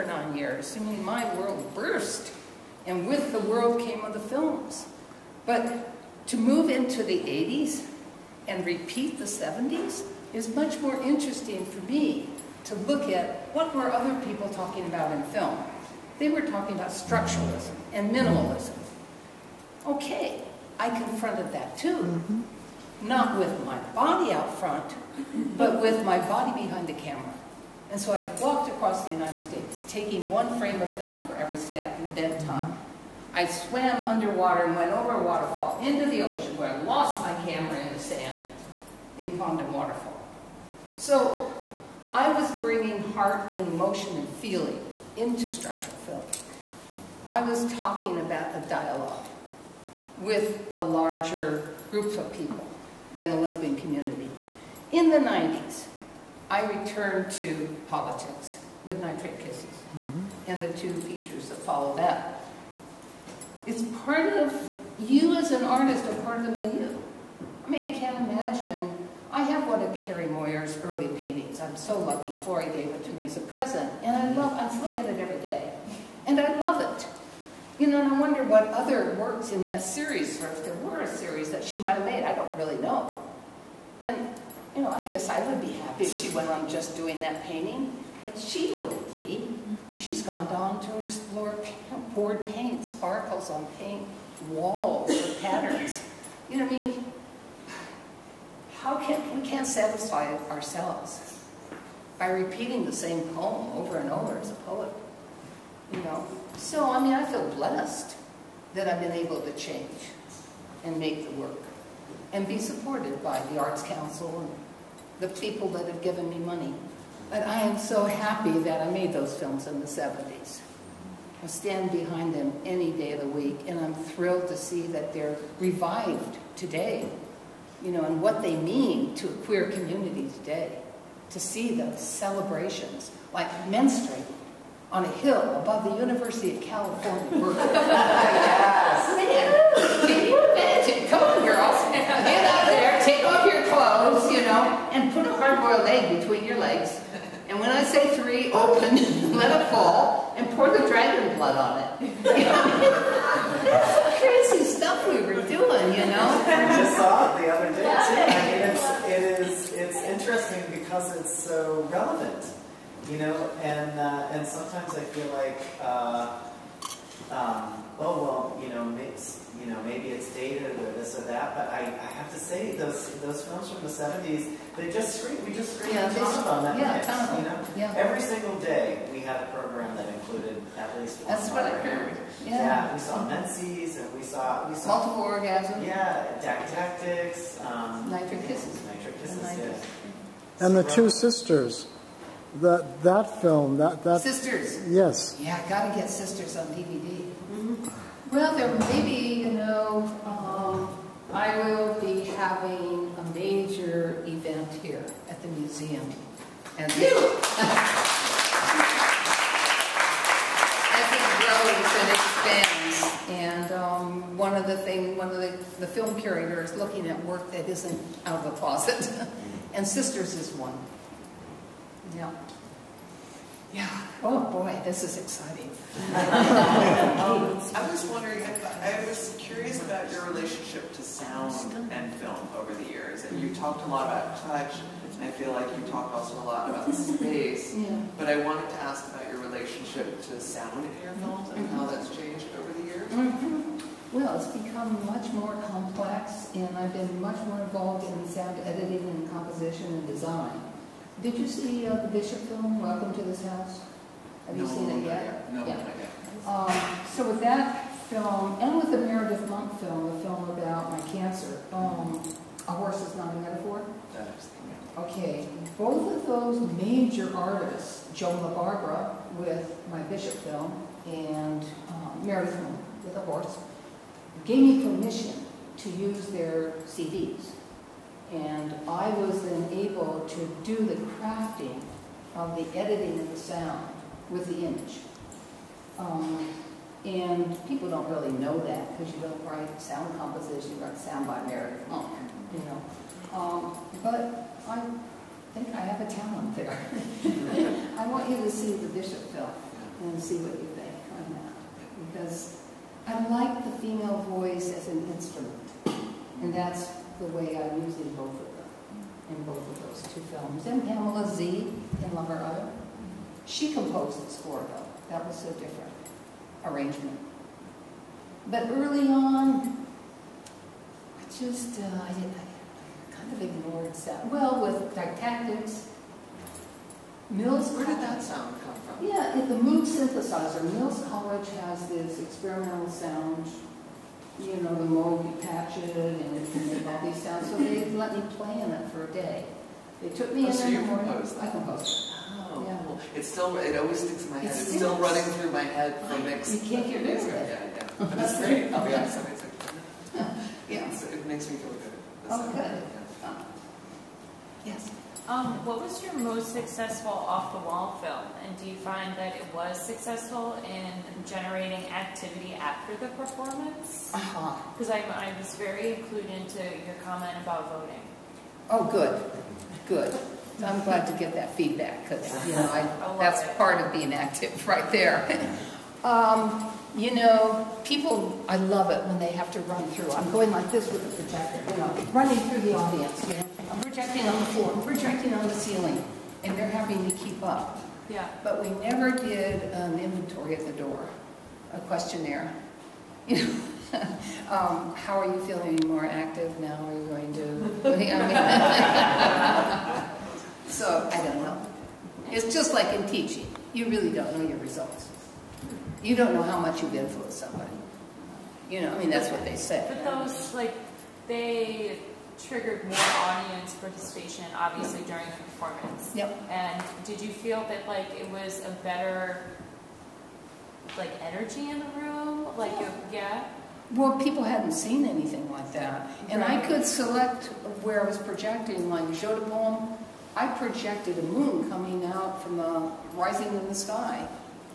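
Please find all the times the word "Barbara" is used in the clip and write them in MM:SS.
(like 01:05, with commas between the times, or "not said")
04:28.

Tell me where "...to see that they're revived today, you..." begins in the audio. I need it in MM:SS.
02:04.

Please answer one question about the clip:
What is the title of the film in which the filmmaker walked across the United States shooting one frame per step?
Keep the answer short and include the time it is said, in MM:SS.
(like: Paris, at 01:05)
Bent Time, at 00:32.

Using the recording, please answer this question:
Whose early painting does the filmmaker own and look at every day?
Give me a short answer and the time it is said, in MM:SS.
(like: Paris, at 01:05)
Carrie Moyer, at 01:09.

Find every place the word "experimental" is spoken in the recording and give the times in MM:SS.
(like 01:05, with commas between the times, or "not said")
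05:32.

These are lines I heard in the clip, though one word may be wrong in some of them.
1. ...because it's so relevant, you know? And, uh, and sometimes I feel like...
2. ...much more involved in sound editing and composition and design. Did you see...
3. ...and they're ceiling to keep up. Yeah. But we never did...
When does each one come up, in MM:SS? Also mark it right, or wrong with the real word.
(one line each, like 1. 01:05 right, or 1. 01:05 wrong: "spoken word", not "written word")
1. 02:40 right
2. 04:07 right
3. 06:26 wrong: "having", not "ceiling".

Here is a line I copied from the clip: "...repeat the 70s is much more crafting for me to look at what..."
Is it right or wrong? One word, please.
wrong.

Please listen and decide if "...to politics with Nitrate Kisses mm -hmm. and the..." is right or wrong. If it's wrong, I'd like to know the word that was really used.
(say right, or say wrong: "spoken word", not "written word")
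right.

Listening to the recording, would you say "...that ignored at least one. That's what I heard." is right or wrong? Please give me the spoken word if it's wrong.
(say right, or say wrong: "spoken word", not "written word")
wrong: "included", not "ignored".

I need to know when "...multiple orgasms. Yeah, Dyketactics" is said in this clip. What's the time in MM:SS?
03:05.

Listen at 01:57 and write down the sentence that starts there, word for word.
But I am so happy that I made those films in the 70s.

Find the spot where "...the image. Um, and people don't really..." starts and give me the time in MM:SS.
04:44.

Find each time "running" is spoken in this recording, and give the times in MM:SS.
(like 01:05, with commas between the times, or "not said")
05:44, 06:22.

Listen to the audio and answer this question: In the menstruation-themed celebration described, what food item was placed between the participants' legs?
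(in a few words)
hard-boiled egg.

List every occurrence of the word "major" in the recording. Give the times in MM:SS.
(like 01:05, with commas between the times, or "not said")
03:23, 04:26.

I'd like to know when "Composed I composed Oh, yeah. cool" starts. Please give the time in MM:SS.
05:41.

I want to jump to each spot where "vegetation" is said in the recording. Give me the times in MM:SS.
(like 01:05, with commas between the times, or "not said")
not said.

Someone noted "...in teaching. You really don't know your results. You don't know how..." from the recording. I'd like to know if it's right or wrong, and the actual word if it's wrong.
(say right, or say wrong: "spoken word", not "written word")
right.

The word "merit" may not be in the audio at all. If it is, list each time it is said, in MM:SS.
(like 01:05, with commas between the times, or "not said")
04:51.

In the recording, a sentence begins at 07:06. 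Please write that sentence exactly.
I could select where I was projecting.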